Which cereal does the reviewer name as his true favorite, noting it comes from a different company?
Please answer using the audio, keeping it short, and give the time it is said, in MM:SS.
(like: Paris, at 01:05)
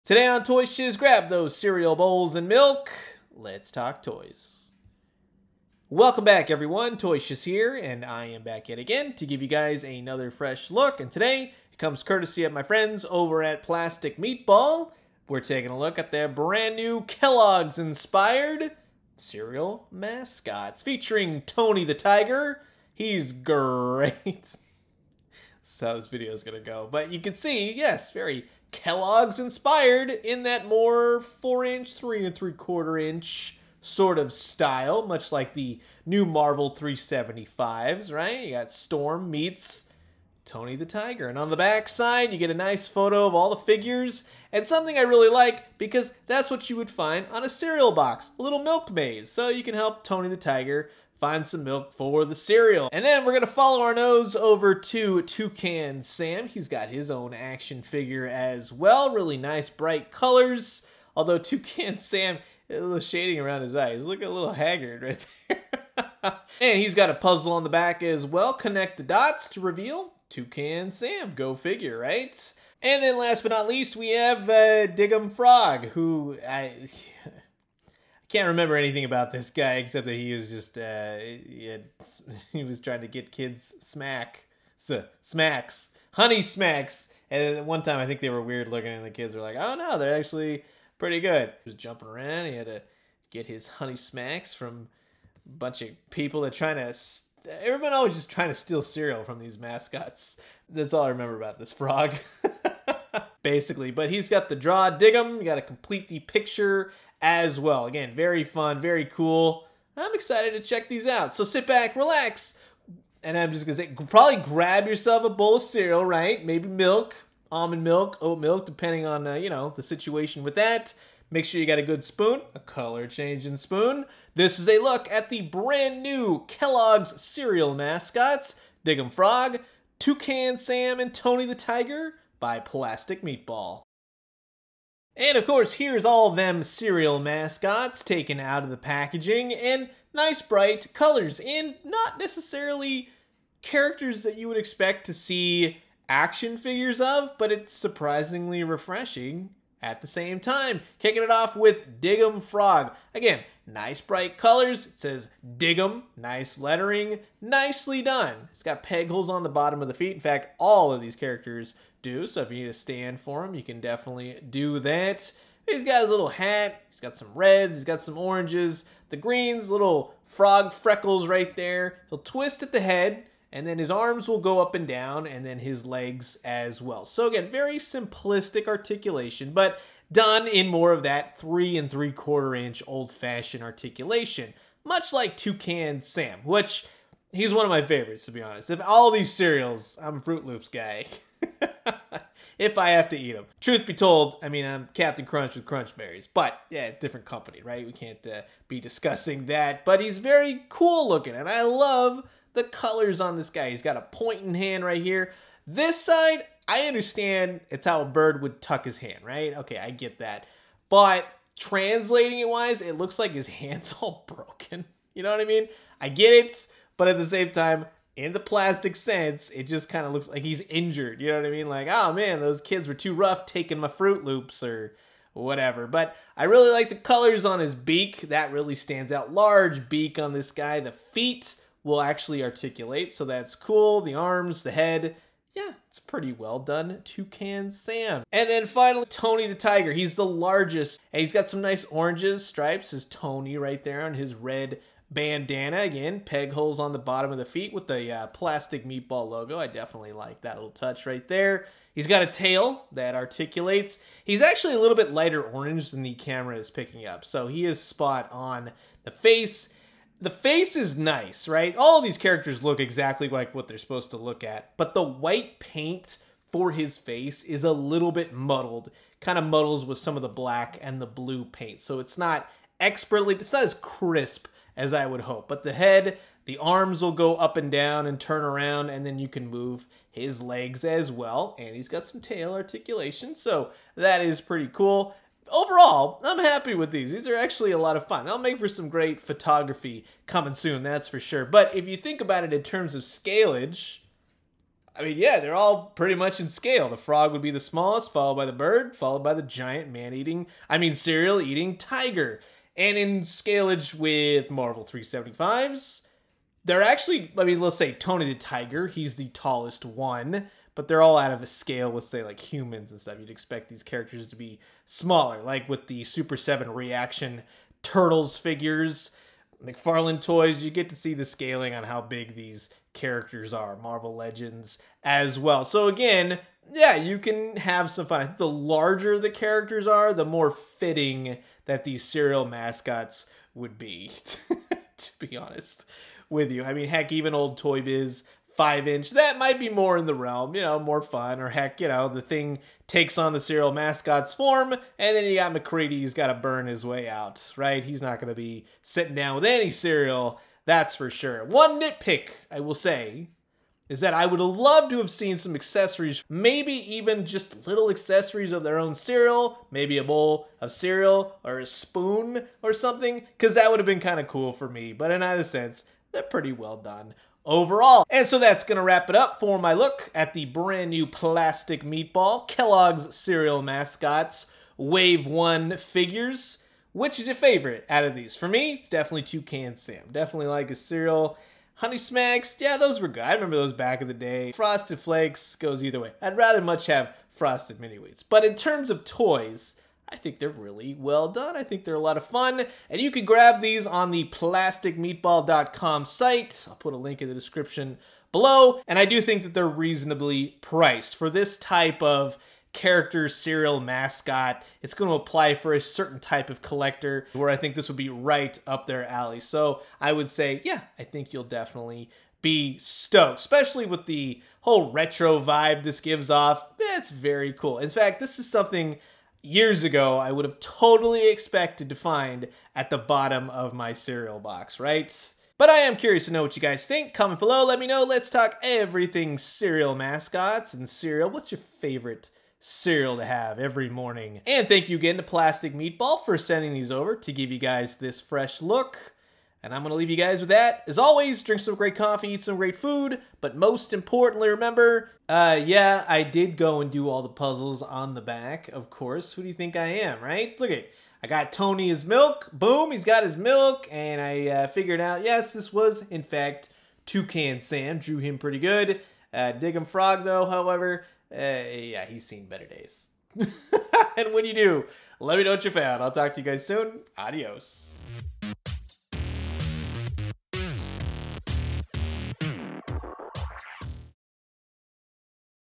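Captain Crunch with Crunch Berries, at 03:14.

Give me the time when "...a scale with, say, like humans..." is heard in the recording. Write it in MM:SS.
05:11.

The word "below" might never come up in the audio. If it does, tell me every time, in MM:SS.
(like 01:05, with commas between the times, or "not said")
06:38, 07:07.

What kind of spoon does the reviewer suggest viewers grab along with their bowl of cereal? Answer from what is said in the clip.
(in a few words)
color changing spoon.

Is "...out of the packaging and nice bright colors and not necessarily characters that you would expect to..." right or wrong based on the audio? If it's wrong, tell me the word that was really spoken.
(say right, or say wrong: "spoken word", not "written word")
right.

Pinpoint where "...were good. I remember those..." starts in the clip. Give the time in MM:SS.
06:23.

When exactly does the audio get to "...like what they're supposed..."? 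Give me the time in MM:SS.
04:23.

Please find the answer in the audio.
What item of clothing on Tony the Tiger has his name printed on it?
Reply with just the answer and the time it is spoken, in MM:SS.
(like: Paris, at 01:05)
red bandana, at 04:04.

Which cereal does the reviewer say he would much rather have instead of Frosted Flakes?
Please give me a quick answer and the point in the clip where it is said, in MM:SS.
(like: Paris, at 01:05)
Frosted Mini Wheats, at 06:27.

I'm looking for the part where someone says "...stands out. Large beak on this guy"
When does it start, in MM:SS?
03:48.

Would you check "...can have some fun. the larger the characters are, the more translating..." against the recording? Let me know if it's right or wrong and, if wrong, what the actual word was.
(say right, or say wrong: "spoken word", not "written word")
wrong: "fitting", not "translating".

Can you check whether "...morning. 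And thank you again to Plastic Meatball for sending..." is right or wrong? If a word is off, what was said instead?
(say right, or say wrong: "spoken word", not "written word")
right.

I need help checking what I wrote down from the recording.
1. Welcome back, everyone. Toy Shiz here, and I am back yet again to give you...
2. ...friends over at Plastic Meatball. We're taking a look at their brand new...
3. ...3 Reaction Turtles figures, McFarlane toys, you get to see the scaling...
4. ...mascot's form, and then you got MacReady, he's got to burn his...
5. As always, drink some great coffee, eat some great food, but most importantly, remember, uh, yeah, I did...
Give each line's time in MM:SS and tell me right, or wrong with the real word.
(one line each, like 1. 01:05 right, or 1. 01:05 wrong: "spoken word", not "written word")
1. 00:05 right
2. 00:12 right
3. 05:16 wrong: "7", not "3"
4. 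05:43 right
5. 07:20 right.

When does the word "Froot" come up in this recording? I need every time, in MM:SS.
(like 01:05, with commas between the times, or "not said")
03:10, 03:43.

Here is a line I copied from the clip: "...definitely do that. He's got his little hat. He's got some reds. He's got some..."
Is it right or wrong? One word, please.
right.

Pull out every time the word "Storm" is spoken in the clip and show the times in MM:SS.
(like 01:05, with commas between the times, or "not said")
00:38.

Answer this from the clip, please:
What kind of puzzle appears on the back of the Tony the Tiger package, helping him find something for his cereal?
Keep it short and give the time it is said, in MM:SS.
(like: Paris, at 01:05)
milk maze, at 00:48.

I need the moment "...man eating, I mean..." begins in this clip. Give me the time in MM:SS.
04:59.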